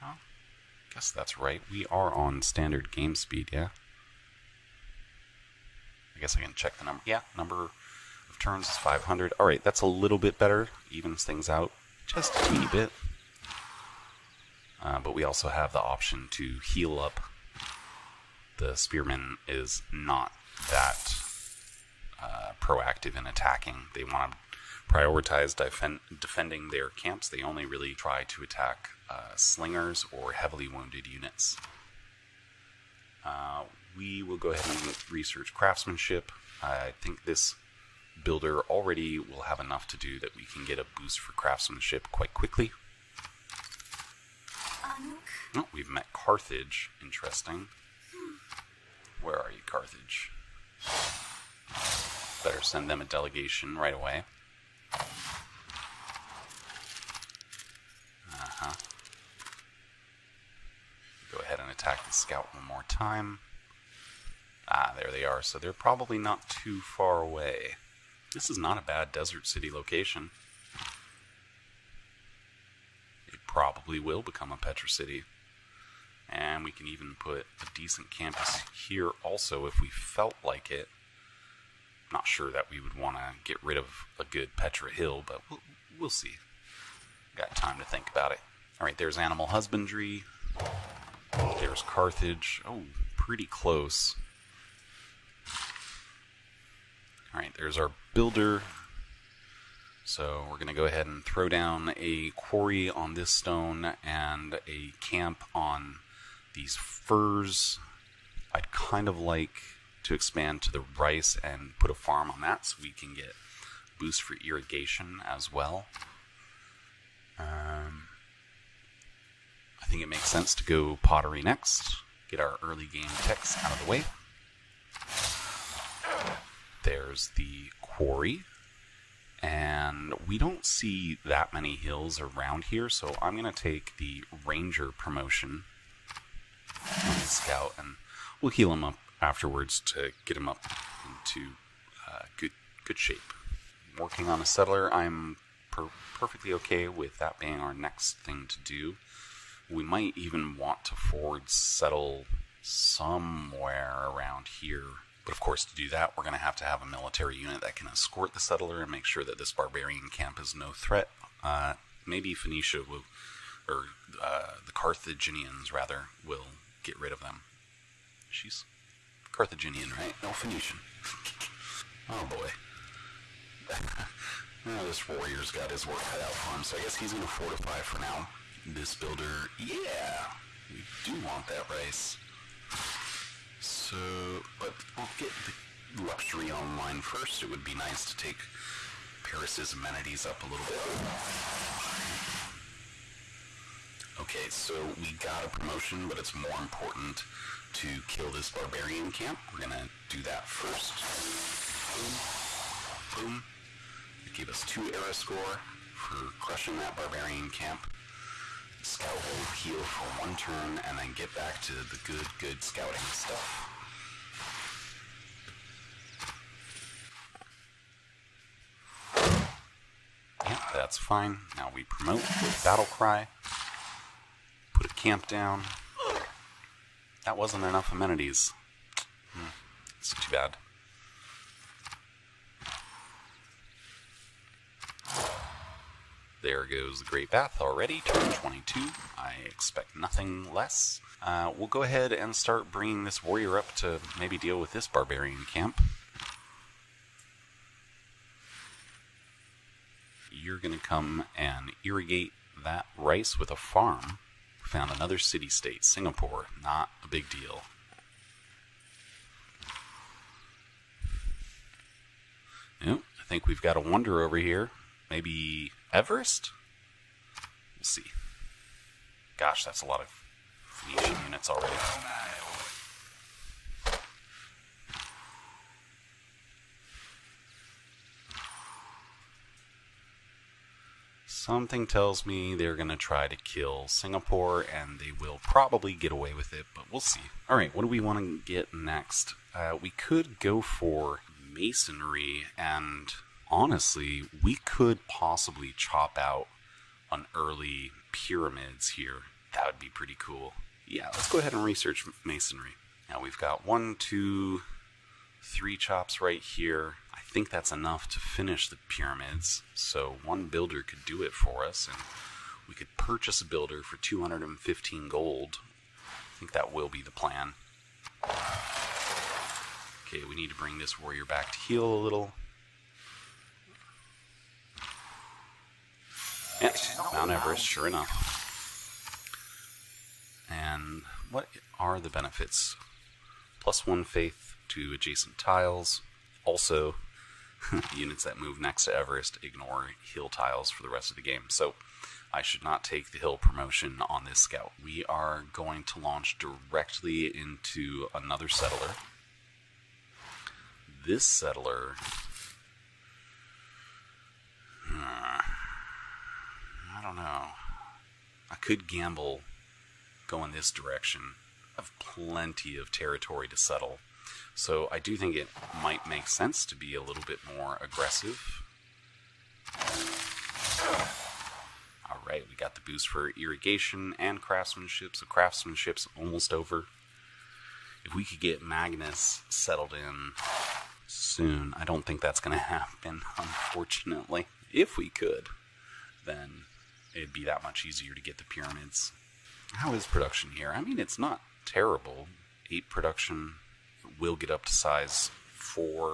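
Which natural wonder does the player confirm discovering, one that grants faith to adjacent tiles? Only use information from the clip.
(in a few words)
Mount Everest.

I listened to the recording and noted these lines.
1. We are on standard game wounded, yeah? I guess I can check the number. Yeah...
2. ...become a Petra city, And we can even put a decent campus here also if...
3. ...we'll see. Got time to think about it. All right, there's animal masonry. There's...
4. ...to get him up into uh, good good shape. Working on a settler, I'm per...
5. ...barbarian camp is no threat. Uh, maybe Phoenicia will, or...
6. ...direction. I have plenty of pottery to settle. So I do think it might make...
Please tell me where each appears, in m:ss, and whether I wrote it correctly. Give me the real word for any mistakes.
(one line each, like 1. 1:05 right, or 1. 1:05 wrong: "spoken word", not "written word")
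1. 0:01 wrong: "speed", not "wounded"
2. 1:14 right
3. 1:25 wrong: "husbandry", not "masonry"
4. 2:19 right
5. 2:39 right
6. 6:00 wrong: "territory", not "pottery".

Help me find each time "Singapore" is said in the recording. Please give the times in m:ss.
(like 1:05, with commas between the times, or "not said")
4:15, 4:43.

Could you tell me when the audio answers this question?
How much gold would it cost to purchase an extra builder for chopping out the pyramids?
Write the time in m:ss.
5:13.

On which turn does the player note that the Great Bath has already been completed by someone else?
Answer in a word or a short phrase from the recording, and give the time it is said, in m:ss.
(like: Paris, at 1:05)
22, at 3:58.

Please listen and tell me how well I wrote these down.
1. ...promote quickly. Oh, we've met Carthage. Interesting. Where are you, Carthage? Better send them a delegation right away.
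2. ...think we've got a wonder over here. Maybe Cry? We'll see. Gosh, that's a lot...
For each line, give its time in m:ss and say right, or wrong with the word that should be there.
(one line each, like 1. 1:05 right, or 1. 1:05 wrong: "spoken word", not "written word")
1. 0:42 wrong: "quite", not "promote"
2. 4:23 wrong: "Everest", not "Cry".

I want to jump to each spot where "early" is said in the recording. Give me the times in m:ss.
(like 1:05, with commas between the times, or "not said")
2:02, 4:57.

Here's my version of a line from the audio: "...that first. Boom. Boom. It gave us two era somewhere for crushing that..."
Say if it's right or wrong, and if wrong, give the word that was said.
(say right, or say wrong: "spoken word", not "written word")
wrong: "score", not "somewhere".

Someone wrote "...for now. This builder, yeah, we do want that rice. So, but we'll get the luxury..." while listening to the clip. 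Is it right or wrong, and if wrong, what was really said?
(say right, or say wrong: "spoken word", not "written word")
right.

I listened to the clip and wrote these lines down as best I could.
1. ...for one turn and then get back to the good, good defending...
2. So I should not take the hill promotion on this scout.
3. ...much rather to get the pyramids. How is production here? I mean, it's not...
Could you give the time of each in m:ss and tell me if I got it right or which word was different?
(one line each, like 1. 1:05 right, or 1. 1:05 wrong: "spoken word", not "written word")
1. 3:29 wrong: "scouting", not "defending"
2. 5:41 right
3. 6:27 wrong: "easier", not "rather".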